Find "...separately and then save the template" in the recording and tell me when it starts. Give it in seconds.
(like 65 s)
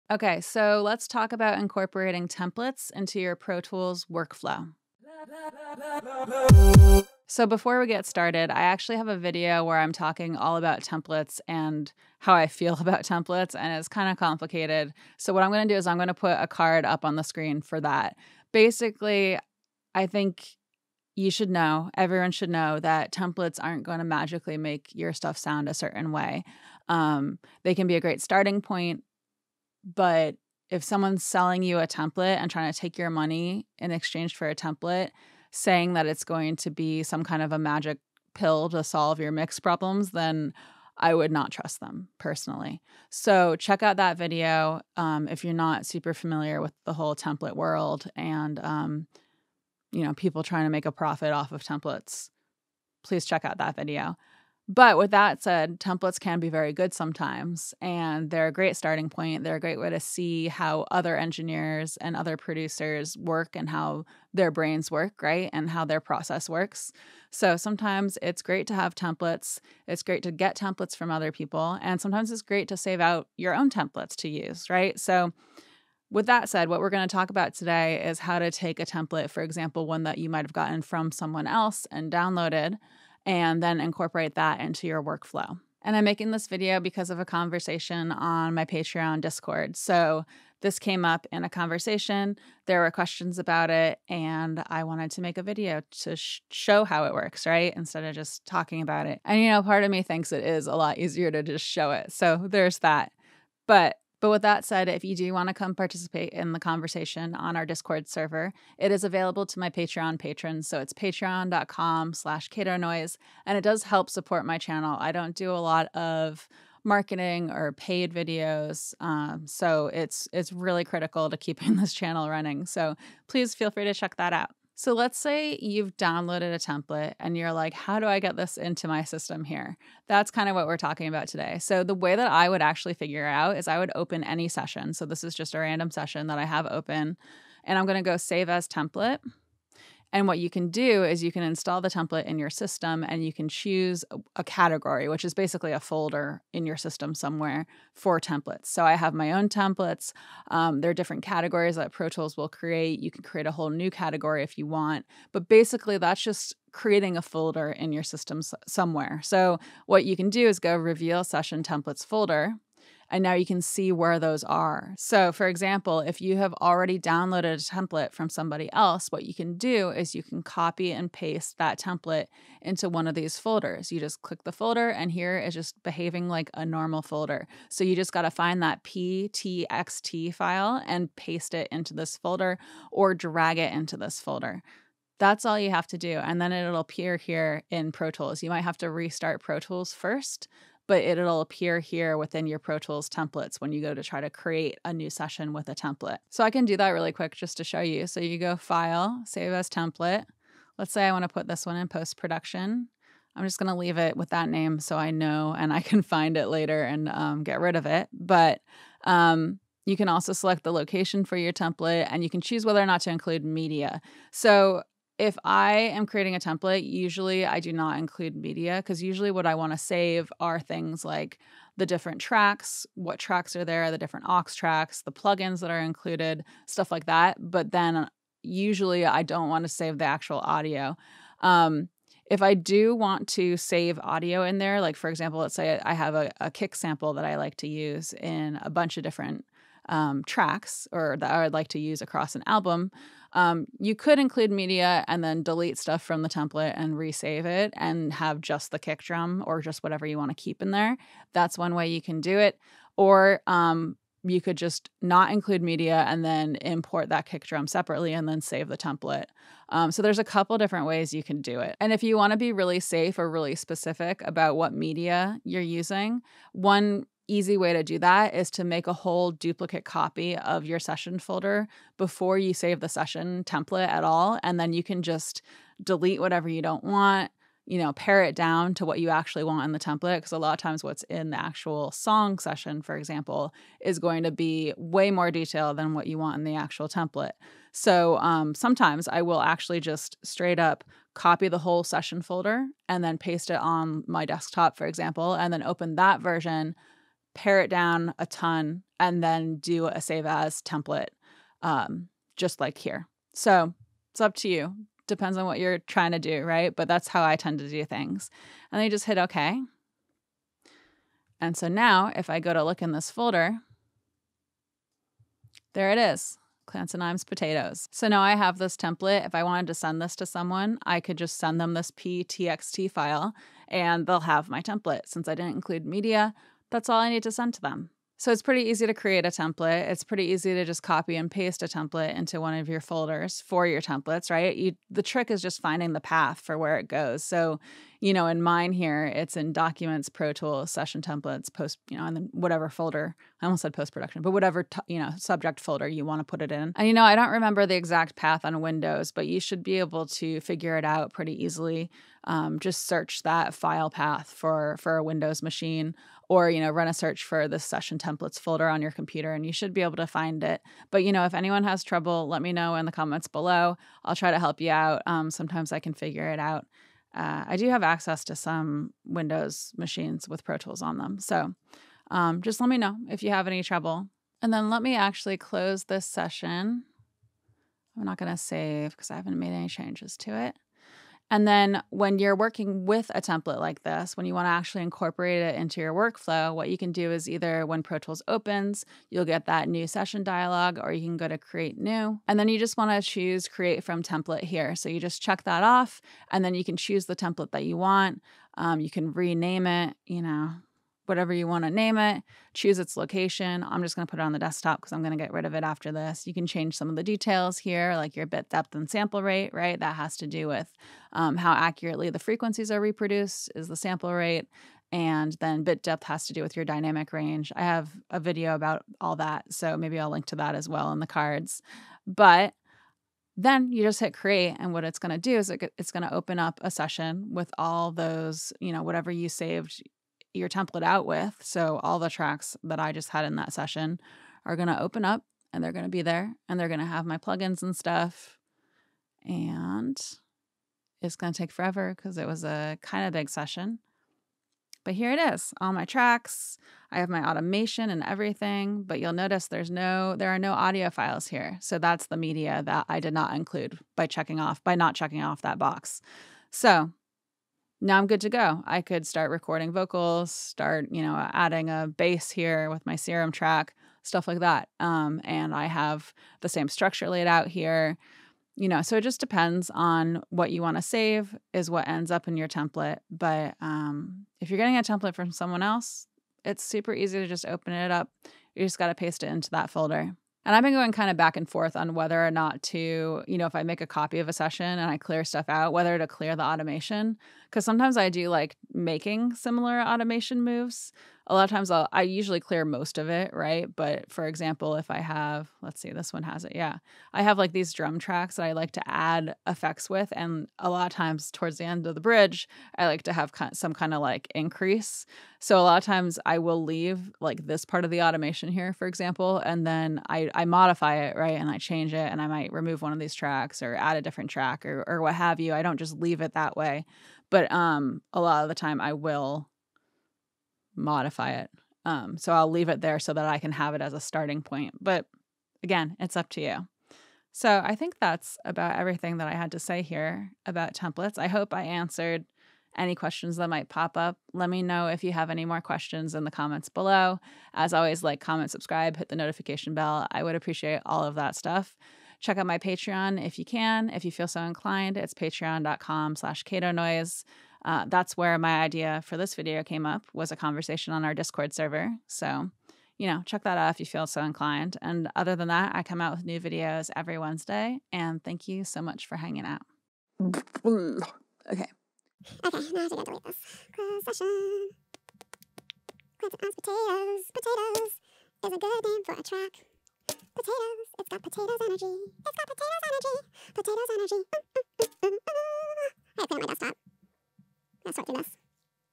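257 s.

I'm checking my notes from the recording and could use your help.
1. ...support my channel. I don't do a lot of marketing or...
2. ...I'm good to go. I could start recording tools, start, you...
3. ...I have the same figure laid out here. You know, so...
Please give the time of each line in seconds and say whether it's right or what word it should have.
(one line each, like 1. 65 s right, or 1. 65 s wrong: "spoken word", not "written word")
1. 114 s right
2. 457 s wrong: "vocals", not "tools"
3. 465 s wrong: "structure", not "figure".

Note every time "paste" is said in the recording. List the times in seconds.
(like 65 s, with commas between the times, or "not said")
171 s, 181 s, 293 s, 331 s, 478 s.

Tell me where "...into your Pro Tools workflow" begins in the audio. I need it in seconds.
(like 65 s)
2 s.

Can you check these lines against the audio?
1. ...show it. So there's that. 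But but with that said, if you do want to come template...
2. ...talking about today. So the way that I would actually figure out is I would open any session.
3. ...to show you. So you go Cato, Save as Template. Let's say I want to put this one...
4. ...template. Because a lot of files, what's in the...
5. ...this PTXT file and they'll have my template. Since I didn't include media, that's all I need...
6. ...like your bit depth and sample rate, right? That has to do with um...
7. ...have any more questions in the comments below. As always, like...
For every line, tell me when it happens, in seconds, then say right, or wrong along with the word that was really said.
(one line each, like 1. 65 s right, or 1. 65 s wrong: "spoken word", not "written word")
1. 101 s wrong: "participate", not "template"
2. 130 s right
3. 197 s wrong: "File", not "Cato"
4. 279 s wrong: "times", not "files"
5. 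321 s right
6. 407 s right
7. 535 s right.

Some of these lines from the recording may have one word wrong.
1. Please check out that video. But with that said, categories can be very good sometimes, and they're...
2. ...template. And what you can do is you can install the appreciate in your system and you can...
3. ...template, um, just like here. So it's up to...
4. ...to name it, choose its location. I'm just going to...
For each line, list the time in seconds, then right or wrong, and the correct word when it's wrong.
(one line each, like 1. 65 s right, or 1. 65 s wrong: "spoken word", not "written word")
1. 53 s wrong: "templates", not "categories"
2. 138 s wrong: "template", not "appreciate"
3. 300 s right
4. 401 s right.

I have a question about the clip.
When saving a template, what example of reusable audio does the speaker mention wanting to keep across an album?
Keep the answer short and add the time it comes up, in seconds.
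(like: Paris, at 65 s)
kick sample, at 236 s.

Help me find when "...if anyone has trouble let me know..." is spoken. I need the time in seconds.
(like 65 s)
361 s.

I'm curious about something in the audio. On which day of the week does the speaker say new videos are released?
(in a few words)
Wednesday.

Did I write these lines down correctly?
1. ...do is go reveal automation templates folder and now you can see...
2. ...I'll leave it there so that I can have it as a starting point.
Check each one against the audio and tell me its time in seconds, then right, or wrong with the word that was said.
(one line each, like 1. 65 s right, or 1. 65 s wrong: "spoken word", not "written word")
1. 160 s wrong: "session", not "automation"
2. 522 s right.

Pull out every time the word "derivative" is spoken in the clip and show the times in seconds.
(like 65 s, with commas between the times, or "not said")
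not said.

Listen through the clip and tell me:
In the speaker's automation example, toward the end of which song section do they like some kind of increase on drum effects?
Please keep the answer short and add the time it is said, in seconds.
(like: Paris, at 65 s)
bridge, at 502 s.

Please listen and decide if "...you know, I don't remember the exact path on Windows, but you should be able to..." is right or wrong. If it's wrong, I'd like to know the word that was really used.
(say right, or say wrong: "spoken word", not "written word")
right.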